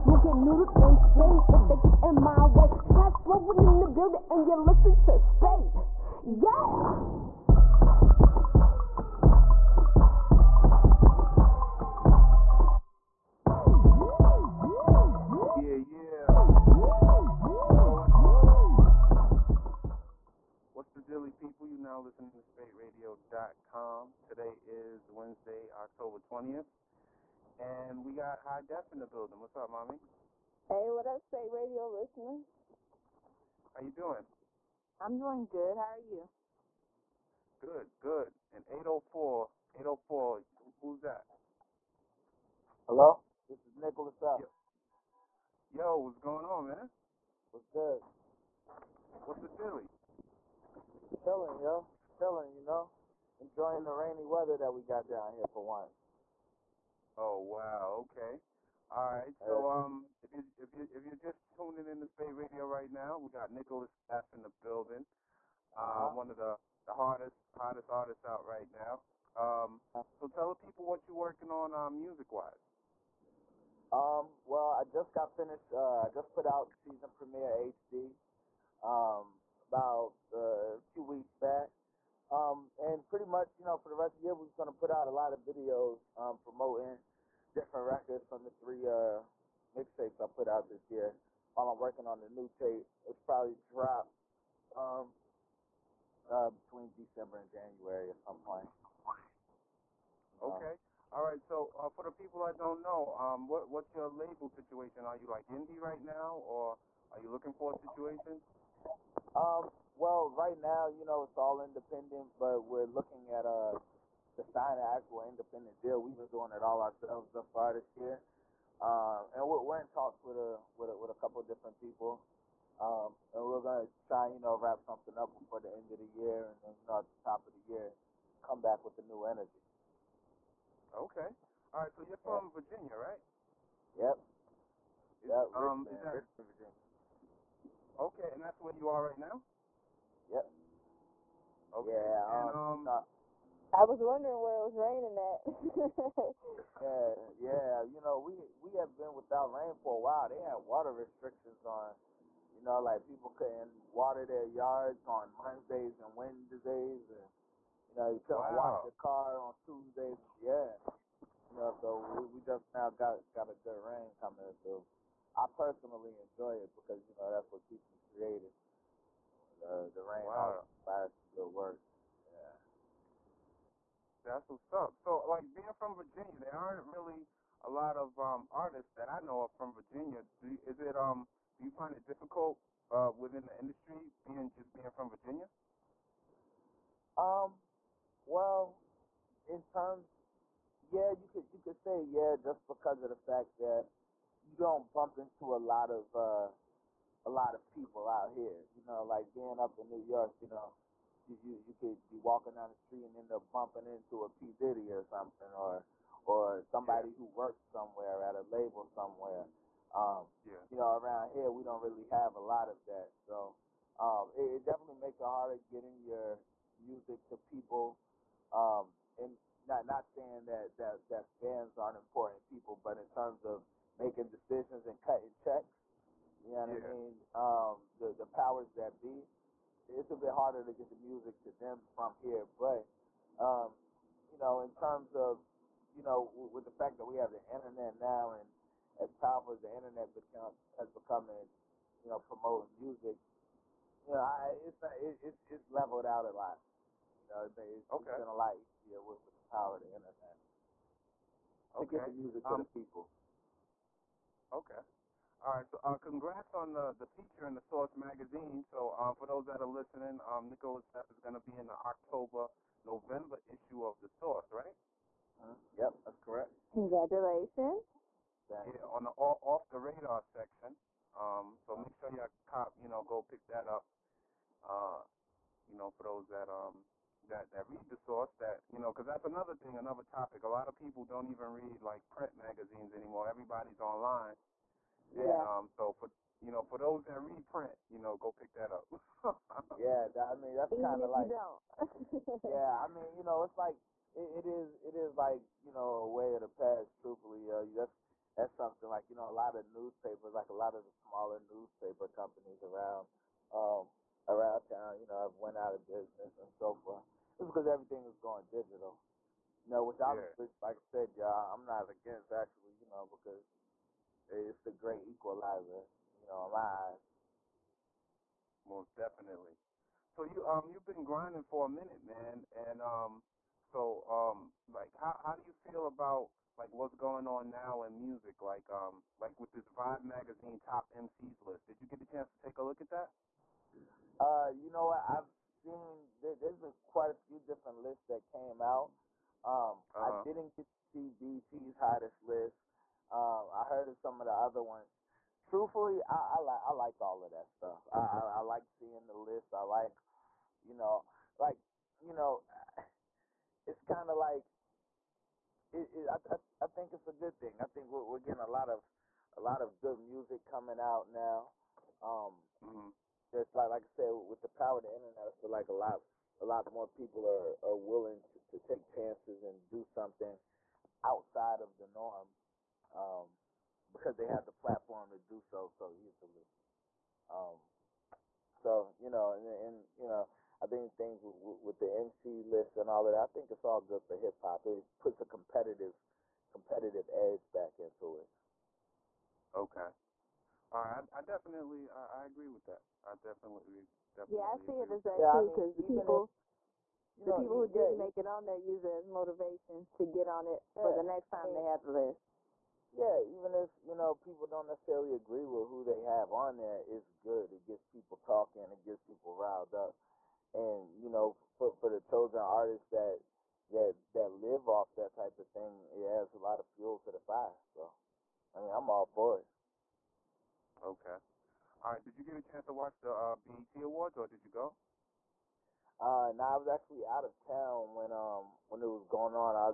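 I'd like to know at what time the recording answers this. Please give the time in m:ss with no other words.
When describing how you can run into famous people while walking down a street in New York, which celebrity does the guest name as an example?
3:24.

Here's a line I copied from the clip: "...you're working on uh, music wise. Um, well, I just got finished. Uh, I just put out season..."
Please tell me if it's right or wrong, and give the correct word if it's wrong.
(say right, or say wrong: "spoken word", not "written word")
right.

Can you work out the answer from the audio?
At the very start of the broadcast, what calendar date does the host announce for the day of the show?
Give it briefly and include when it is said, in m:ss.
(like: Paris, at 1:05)
October 20th, at 0:25.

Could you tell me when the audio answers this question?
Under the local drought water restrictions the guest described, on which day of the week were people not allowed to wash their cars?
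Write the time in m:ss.
2:39.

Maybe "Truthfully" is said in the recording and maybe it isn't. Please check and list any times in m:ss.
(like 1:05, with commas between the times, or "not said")
4:57, 5:45.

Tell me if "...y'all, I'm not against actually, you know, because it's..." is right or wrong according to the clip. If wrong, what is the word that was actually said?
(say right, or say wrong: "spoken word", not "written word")
right.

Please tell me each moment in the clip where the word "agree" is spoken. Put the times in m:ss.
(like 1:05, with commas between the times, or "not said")
6:32, 6:45.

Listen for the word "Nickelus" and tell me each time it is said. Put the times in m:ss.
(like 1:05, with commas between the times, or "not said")
1:03, 4:20.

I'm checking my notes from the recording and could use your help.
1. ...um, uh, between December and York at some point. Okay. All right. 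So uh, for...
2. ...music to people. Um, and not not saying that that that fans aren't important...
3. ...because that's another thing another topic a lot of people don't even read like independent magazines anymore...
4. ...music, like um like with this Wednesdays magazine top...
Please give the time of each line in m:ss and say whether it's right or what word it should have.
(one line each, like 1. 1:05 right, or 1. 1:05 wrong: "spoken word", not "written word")
1. 1:34 wrong: "January", not "York"
2. 3:36 right
3. 4:38 wrong: "print", not "independent"
4. 5:28 wrong: "Vibe", not "Wednesdays".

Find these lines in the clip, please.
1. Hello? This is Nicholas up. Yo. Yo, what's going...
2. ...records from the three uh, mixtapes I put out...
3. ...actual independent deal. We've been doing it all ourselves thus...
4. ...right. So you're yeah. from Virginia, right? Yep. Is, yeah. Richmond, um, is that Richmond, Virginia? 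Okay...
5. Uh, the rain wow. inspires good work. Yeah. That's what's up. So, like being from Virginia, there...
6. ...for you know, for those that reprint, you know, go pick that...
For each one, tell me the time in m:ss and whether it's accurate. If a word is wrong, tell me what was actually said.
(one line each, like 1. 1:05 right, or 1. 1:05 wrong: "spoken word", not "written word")
1. 0:42 right
2. 1:27 right
3. 1:54 right
4. 2:11 right
5. 2:49 right
6. 4:46 right.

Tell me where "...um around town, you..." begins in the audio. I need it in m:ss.
5:03.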